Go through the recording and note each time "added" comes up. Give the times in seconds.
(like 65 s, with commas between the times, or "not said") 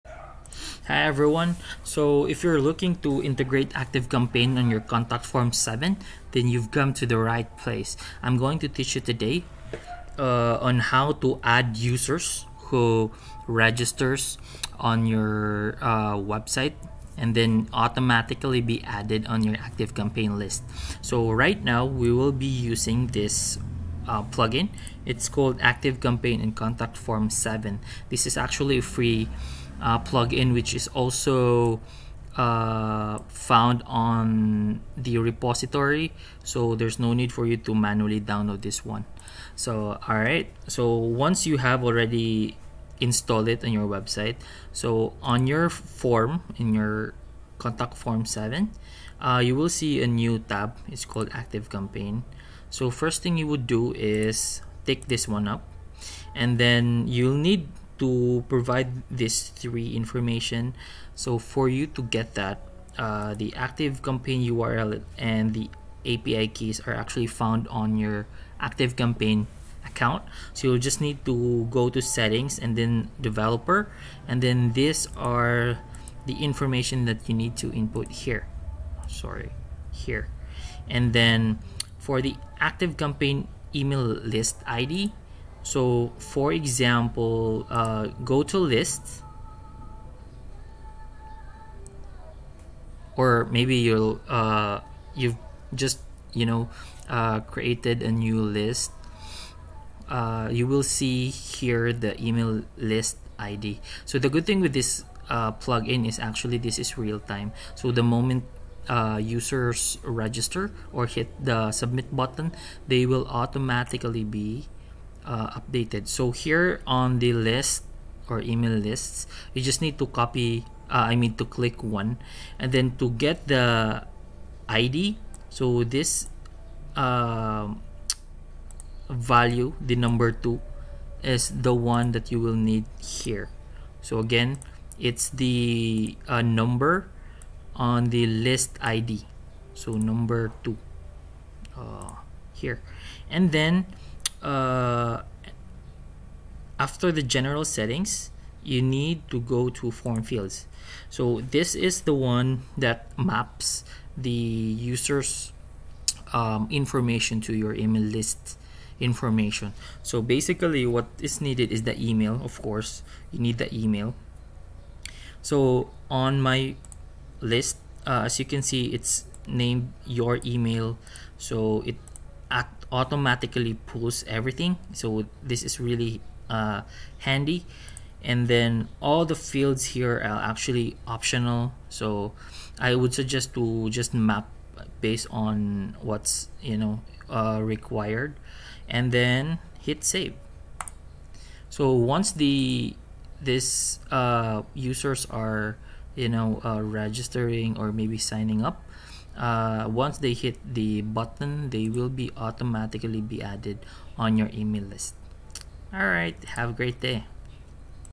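18 s, 203 s.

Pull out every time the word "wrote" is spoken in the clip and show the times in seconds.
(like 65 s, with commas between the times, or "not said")
not said.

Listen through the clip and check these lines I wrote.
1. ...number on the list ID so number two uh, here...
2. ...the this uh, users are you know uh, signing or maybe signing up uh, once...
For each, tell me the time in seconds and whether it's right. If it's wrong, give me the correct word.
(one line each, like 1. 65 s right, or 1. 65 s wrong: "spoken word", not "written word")
1. 136 s right
2. 192 s wrong: "registering", not "signing".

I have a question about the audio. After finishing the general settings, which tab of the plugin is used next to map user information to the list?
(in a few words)
Form fields.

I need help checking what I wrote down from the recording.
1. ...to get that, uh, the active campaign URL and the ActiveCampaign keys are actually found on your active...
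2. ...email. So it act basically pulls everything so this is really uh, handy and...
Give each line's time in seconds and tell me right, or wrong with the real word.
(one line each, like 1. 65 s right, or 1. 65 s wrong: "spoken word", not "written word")
1. 61 s wrong: "API", not "ActiveCampaign"
2. 170 s wrong: "automatically", not "basically".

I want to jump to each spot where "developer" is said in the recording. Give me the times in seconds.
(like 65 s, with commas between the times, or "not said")
73 s.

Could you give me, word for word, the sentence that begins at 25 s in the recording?
It's called ActiveCampaign and Contact Form 7.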